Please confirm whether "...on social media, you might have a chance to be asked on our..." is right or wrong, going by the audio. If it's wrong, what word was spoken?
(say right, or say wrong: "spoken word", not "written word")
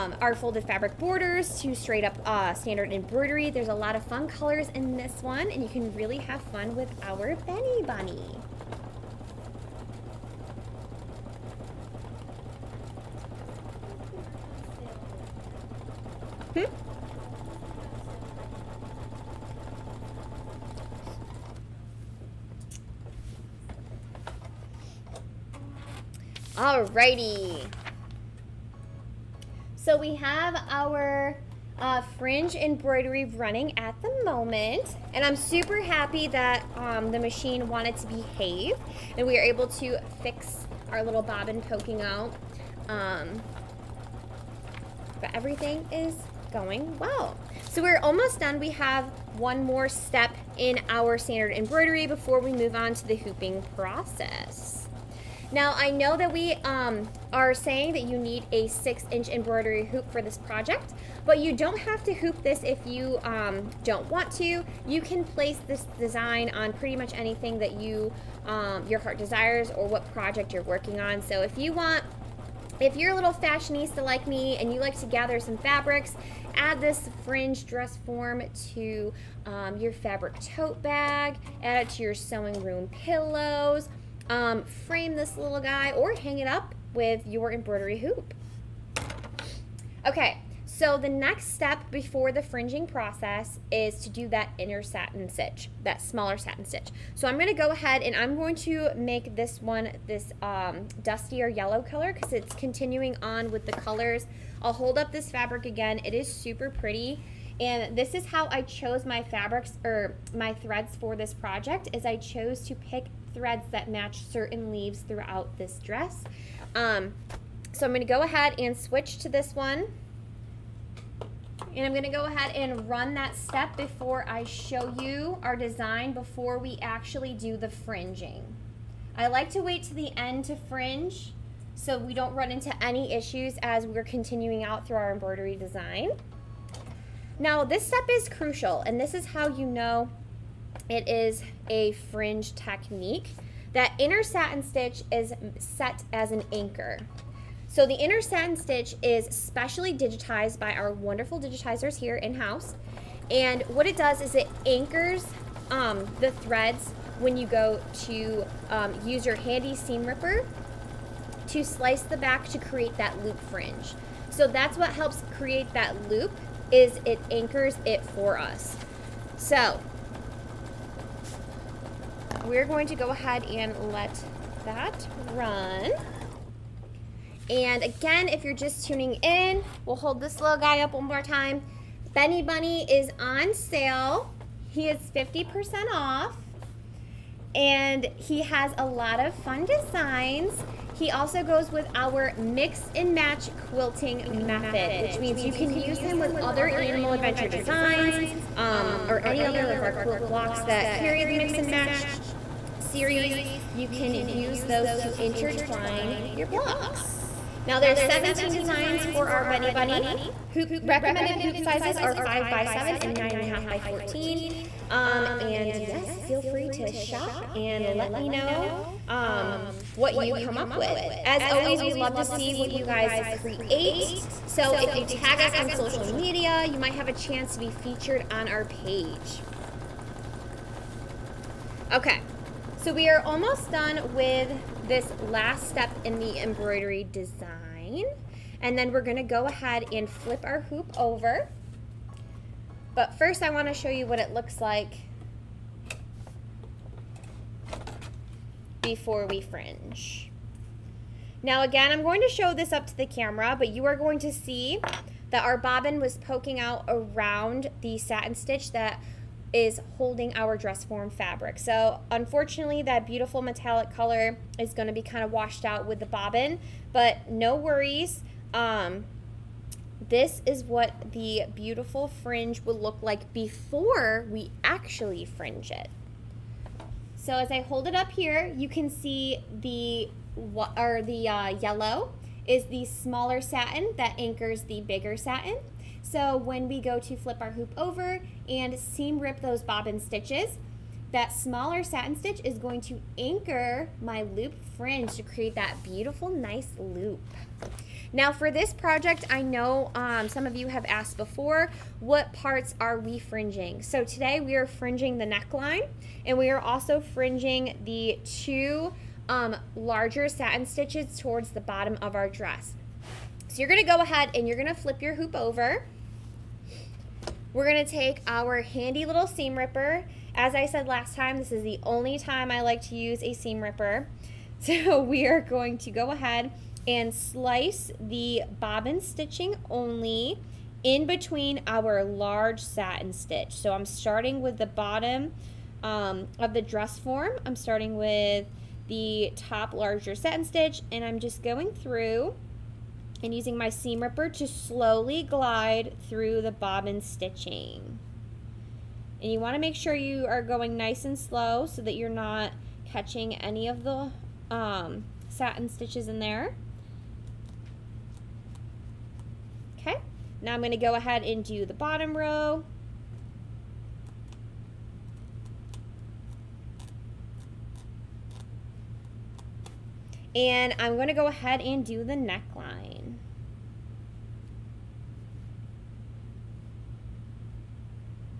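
wrong: "featured", not "asked".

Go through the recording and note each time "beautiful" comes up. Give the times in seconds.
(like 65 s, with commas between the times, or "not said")
263 s, 271 s, 295 s.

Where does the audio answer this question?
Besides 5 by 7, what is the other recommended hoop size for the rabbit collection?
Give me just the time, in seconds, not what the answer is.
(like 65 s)
213 s.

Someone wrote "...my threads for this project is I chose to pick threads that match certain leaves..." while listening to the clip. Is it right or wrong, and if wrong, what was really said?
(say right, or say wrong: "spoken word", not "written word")
right.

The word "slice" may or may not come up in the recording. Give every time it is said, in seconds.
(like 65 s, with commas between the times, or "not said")
161 s, 327 s.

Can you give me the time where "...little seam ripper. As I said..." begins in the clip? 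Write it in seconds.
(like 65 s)
319 s.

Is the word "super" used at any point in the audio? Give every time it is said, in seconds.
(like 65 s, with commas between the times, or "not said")
35 s, 106 s.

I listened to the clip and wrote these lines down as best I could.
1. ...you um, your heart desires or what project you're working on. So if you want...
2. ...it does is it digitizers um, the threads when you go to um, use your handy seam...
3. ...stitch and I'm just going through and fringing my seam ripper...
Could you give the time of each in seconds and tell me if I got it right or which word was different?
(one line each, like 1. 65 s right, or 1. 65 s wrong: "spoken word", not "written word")
1. 67 s right
2. 153 s wrong: "anchors", not "digitizers"
3. 340 s wrong: "using", not "fringing".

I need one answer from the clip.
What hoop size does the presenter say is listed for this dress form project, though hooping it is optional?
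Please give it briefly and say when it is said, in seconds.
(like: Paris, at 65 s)
6 inch, at 58 s.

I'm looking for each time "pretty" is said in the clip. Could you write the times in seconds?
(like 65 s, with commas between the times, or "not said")
66 s, 106 s.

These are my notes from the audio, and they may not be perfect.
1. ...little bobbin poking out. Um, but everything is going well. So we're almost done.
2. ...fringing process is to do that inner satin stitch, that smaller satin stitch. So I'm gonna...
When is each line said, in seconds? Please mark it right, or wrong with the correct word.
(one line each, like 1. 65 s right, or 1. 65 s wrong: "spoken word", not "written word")
1. 41 s right
2. 92 s right.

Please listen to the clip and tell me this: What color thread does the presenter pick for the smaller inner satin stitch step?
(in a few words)
dustier yellow.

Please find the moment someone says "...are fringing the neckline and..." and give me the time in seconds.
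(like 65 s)
304 s.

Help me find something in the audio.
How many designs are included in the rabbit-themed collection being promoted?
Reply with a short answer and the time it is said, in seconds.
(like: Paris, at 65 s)
17, at 208 s.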